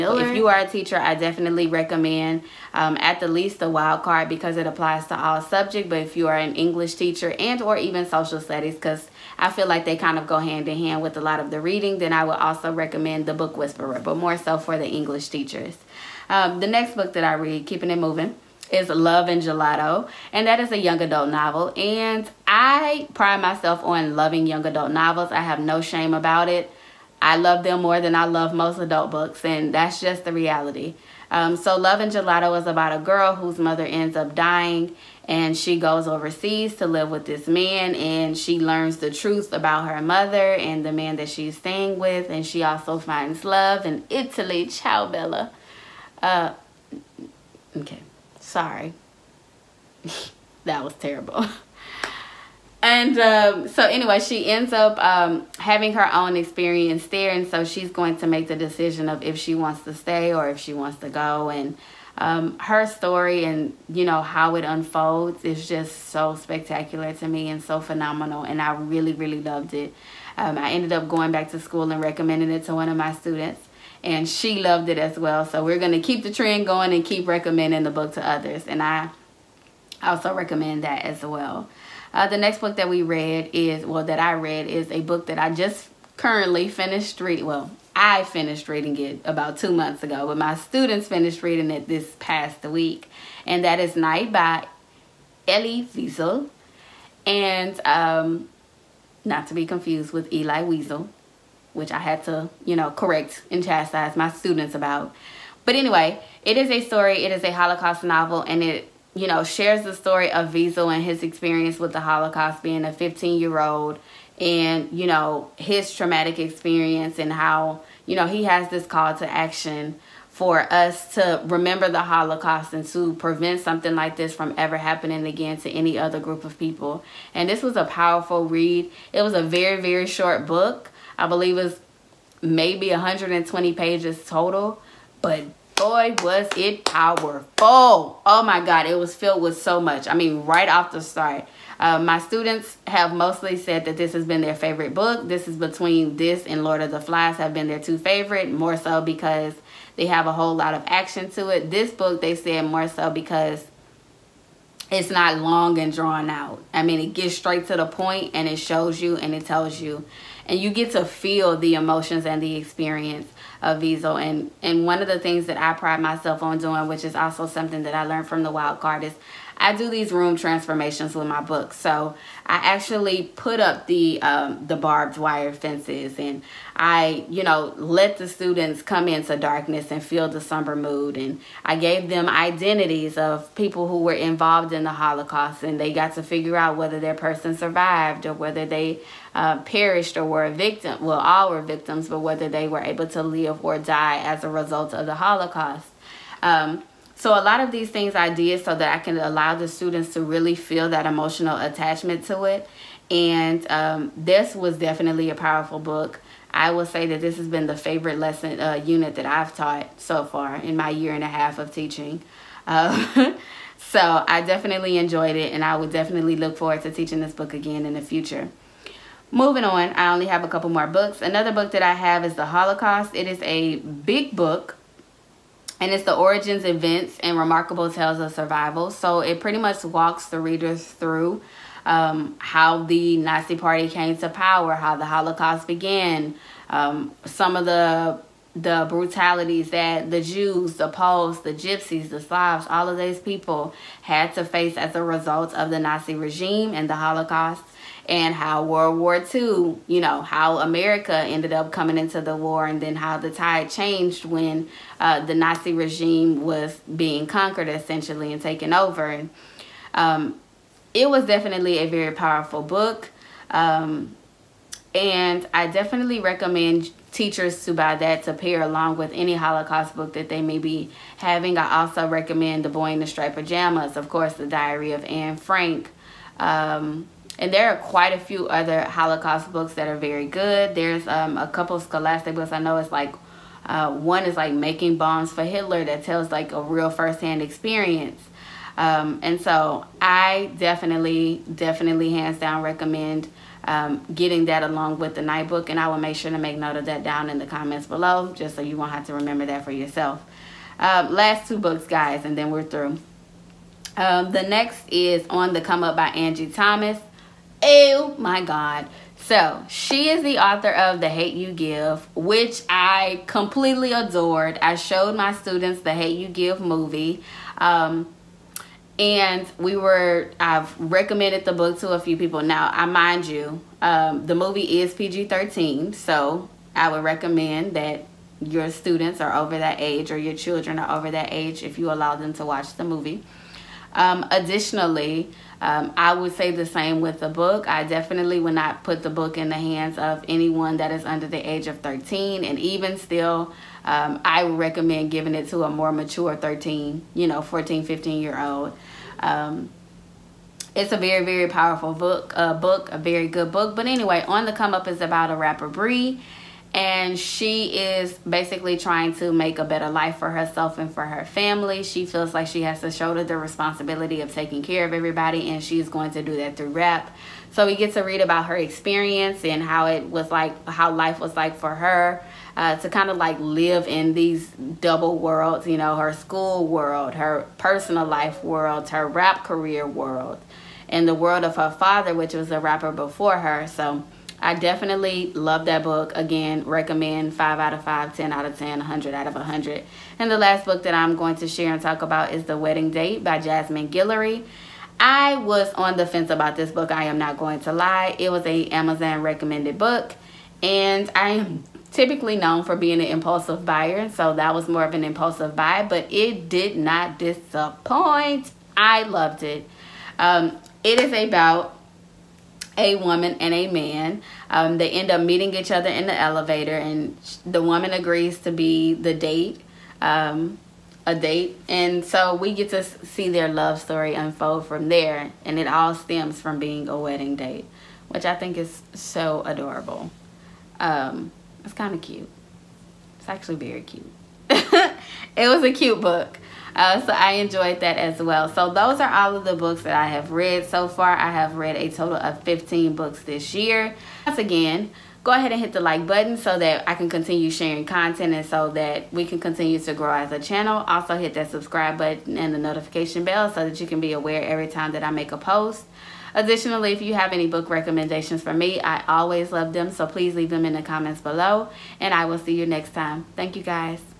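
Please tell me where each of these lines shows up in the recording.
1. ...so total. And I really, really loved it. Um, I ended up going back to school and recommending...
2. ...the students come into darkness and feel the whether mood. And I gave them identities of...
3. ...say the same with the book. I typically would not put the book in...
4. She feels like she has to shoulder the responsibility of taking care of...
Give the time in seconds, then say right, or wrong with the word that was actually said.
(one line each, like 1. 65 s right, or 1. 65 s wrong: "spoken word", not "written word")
1. 67 s wrong: "phenomenal", not "total"
2. 178 s wrong: "somber", not "whether"
3. 336 s wrong: "definitely", not "typically"
4. 361 s right.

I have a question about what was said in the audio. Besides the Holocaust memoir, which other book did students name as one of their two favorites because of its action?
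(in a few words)
Lord of the Flies.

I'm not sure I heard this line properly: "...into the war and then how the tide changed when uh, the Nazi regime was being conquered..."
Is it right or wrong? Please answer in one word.
right.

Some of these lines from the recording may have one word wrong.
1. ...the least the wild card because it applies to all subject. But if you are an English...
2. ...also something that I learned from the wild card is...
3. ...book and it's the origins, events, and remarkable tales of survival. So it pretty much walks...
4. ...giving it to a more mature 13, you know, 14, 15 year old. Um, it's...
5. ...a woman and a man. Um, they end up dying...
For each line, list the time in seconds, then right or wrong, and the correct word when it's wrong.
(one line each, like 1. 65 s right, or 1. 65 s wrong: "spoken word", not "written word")
1. 3 s right
2. 167 s right
3. 224 s right
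4. 345 s right
5. 412 s wrong: "meeting", not "dying".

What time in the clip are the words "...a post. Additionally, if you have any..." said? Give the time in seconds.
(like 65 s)
455 s.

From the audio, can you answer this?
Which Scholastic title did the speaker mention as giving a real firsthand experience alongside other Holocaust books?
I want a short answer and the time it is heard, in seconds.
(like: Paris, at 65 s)
Making Bombs for Hitler, at 284 s.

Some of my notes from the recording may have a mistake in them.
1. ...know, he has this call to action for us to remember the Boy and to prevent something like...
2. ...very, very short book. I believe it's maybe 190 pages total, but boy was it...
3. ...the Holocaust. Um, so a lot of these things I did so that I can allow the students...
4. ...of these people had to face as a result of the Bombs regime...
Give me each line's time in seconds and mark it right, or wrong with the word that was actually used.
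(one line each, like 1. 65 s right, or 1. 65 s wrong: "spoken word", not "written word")
1. 118 s wrong: "Holocaust", not "Boy"
2. 129 s wrong: "120", not "190"
3. 195 s right
4. 242 s wrong: "Nazi", not "Bombs".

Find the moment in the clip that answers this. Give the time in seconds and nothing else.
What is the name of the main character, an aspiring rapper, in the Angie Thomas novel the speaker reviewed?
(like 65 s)
355 s.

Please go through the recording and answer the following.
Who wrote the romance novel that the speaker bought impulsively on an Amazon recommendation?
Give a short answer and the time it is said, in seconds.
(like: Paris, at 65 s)
Jasmine Guillory, at 393 s.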